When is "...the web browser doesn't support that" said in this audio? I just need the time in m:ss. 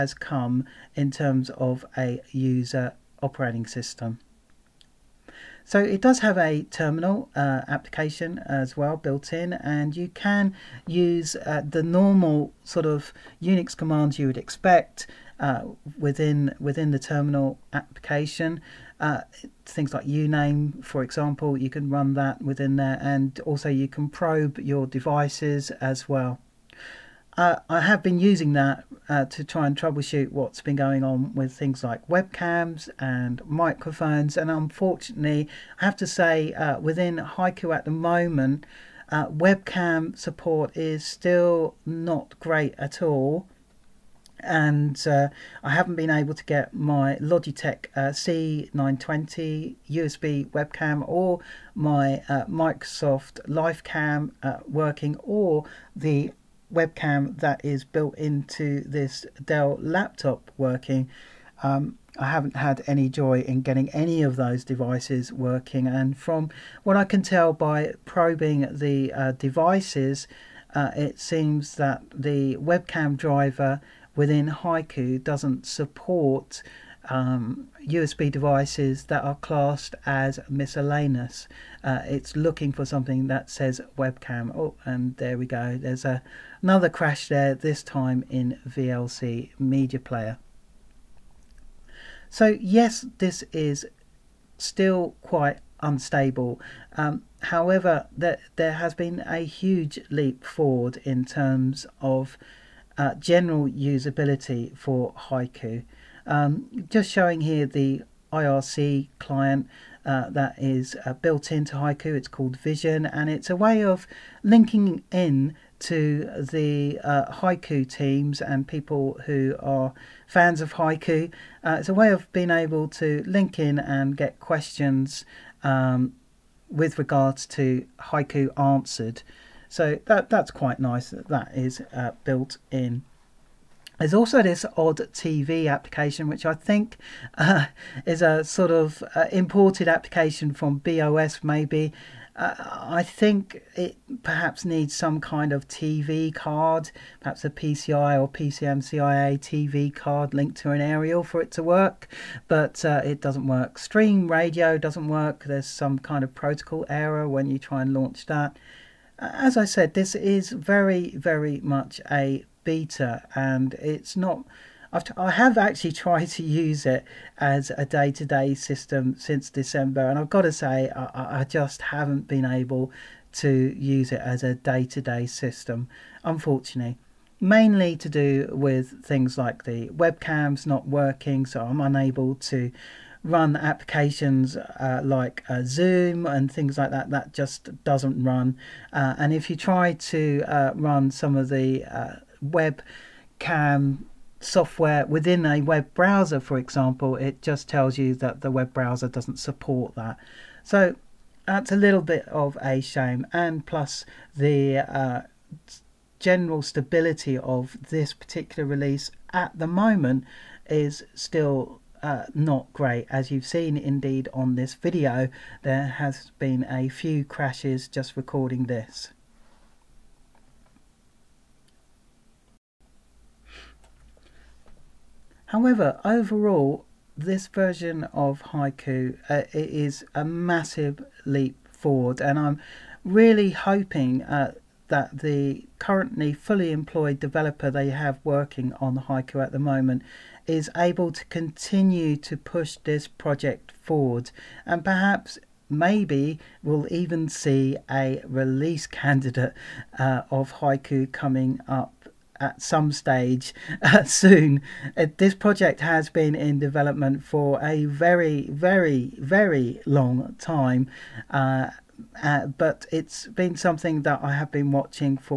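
3:18.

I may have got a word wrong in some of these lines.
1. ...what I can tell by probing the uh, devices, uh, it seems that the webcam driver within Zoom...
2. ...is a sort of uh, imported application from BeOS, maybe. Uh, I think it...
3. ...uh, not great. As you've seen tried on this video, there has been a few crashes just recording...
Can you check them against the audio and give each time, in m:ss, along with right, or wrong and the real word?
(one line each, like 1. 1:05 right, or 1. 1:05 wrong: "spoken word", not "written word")
1. 1:06 wrong: "Haiku", not "Zoom"
2. 2:18 right
3. 3:32 wrong: "indeed", not "tried".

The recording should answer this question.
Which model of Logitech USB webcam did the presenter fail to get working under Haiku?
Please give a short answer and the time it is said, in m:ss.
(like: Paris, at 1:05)
C920, at 0:48.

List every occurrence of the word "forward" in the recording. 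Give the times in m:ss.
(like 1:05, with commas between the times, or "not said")
1:40, 3:51, 4:03.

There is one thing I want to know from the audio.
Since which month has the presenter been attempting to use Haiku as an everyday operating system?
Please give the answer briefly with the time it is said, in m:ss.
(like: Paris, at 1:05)
December, at 2:49.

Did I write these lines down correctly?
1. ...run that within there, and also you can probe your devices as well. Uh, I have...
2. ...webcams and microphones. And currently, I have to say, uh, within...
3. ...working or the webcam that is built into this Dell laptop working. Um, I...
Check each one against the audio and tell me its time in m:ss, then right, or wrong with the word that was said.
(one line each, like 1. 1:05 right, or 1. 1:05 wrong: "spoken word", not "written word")
1. 0:21 right
2. 0:32 wrong: "unfortunately", not "currently"
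3. 0:54 right.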